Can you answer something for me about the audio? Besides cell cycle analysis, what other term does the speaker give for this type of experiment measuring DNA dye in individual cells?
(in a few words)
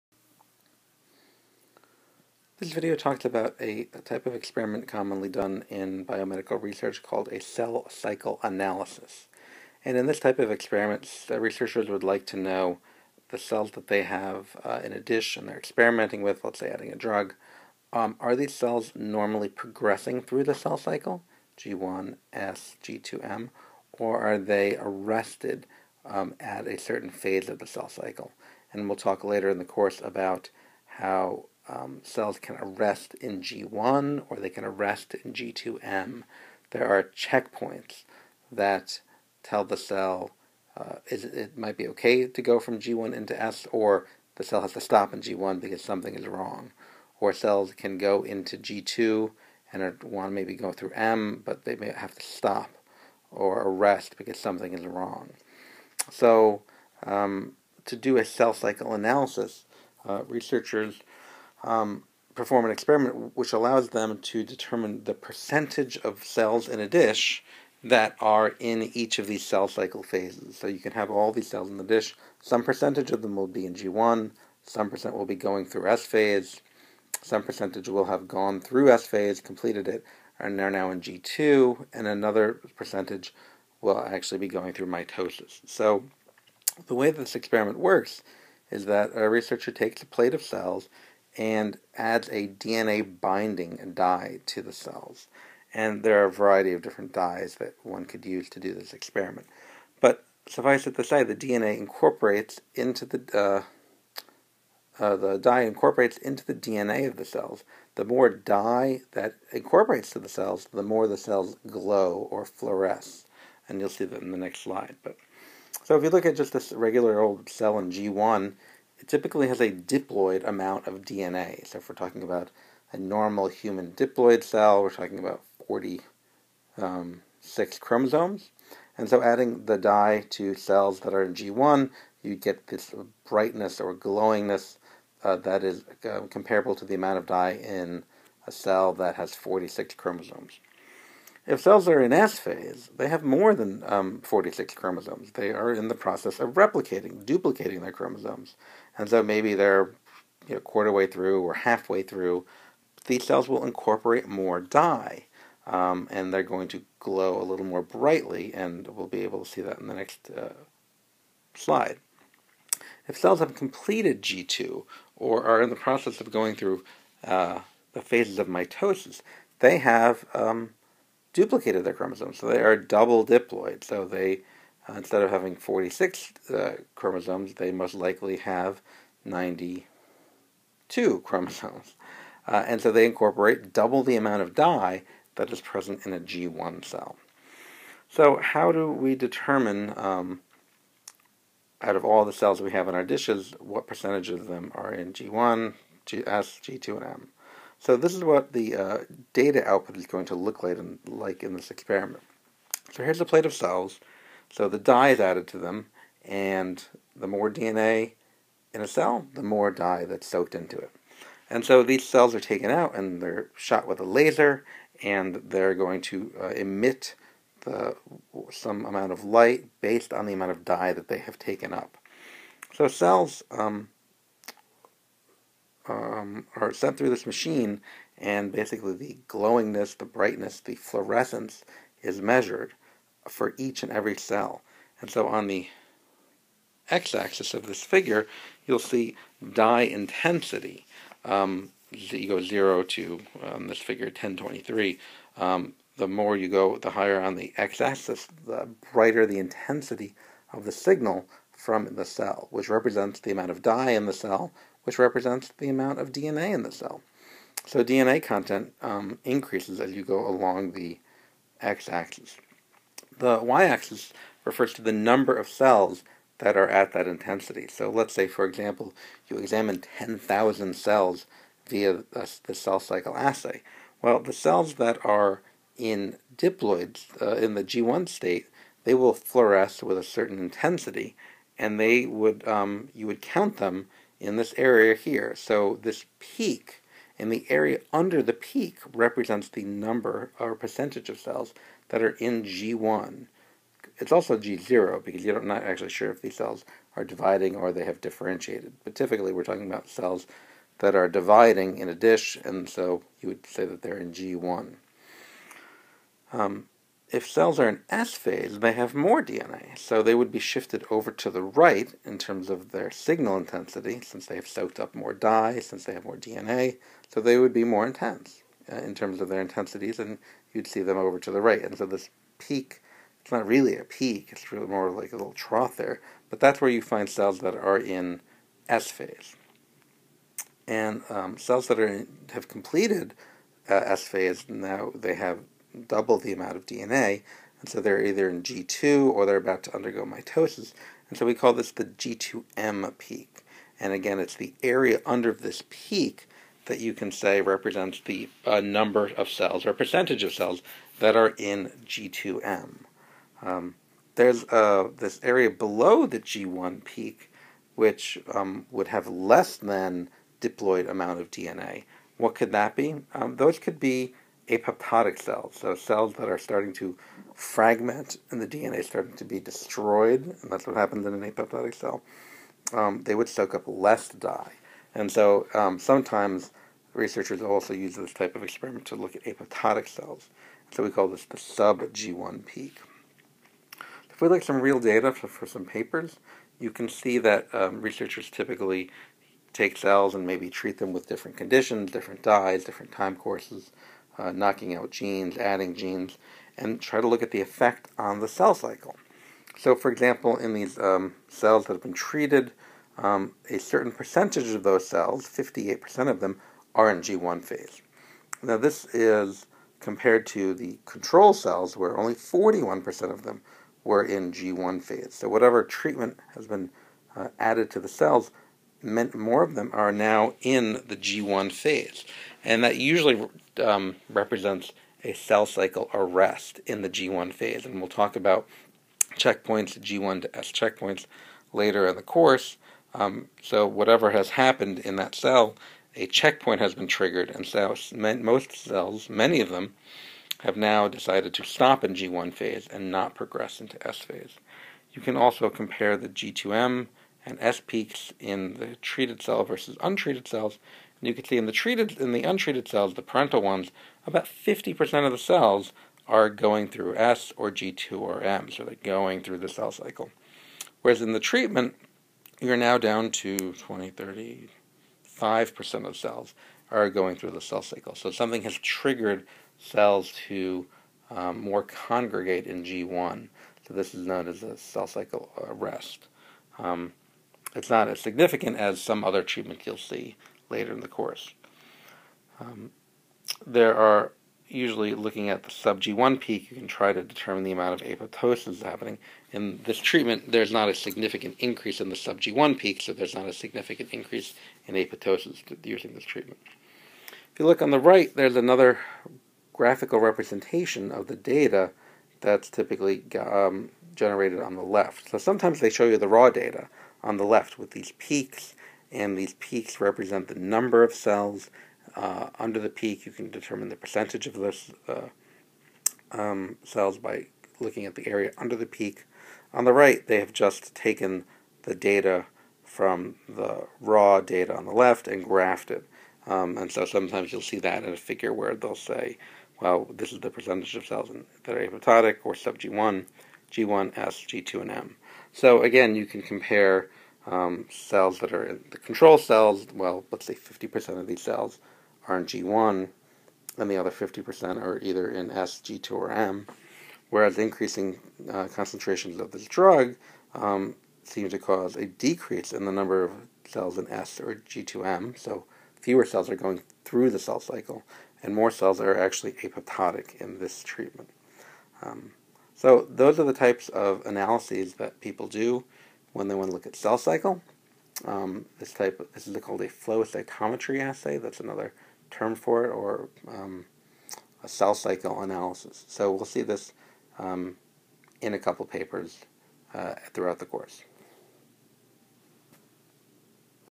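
flow cytometry assay.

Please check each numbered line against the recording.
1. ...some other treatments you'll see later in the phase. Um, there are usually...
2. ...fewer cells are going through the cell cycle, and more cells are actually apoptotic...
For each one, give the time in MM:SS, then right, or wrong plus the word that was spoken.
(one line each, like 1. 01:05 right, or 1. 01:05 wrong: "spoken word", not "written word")
1. 07:58 wrong: "course", not "phase"
2. 09:15 right.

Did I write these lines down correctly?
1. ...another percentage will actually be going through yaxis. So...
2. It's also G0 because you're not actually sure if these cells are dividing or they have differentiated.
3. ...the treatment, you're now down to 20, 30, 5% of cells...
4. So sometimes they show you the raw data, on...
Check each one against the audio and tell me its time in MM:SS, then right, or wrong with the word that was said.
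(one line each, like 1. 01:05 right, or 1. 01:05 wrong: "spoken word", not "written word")
1. 01:22 wrong: "mitosis", not "yaxis"
2. 04:53 right
3. 07:41 right
4. 08:25 right.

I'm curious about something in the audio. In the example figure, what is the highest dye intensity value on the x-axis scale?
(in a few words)
1023.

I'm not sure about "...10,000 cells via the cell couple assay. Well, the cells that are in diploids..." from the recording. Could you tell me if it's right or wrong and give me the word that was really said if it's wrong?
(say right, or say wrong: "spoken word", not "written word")
wrong: "cycle", not "couple".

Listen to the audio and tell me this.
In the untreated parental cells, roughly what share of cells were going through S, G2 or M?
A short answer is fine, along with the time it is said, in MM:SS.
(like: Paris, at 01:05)
50%, at 07:34.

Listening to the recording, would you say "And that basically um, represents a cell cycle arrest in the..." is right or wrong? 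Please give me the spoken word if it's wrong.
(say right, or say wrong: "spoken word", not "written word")
wrong: "usually", not "basically".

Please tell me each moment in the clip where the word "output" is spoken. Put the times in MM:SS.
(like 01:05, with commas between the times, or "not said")
03:19.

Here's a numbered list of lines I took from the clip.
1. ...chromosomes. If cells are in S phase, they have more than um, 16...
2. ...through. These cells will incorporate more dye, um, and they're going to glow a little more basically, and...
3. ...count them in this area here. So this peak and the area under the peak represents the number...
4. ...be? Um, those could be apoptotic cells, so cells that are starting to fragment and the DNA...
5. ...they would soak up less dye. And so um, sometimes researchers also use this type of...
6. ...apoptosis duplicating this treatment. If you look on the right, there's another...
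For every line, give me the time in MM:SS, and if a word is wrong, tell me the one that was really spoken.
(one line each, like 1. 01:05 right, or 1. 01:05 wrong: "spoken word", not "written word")
1. 02:19 wrong: "46", not "16"
2. 02:32 wrong: "brightly", not "basically"
3. 04:43 right
4. 06:02 right
5. 06:13 right
6. 08:14 wrong: "using", not "duplicating".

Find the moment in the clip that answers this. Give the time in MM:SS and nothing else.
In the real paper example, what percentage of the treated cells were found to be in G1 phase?
06:45.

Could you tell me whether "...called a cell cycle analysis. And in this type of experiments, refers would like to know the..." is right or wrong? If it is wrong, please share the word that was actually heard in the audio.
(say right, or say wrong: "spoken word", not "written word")
wrong: "researchers", not "refers".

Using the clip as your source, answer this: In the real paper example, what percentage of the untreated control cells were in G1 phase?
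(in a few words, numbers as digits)
41%.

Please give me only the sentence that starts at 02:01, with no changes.
So if we're talking about a normal human diploid cell, we're talking about 46 um, chromosomes.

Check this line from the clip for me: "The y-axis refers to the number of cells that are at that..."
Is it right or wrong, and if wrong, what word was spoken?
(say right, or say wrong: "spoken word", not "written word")
right.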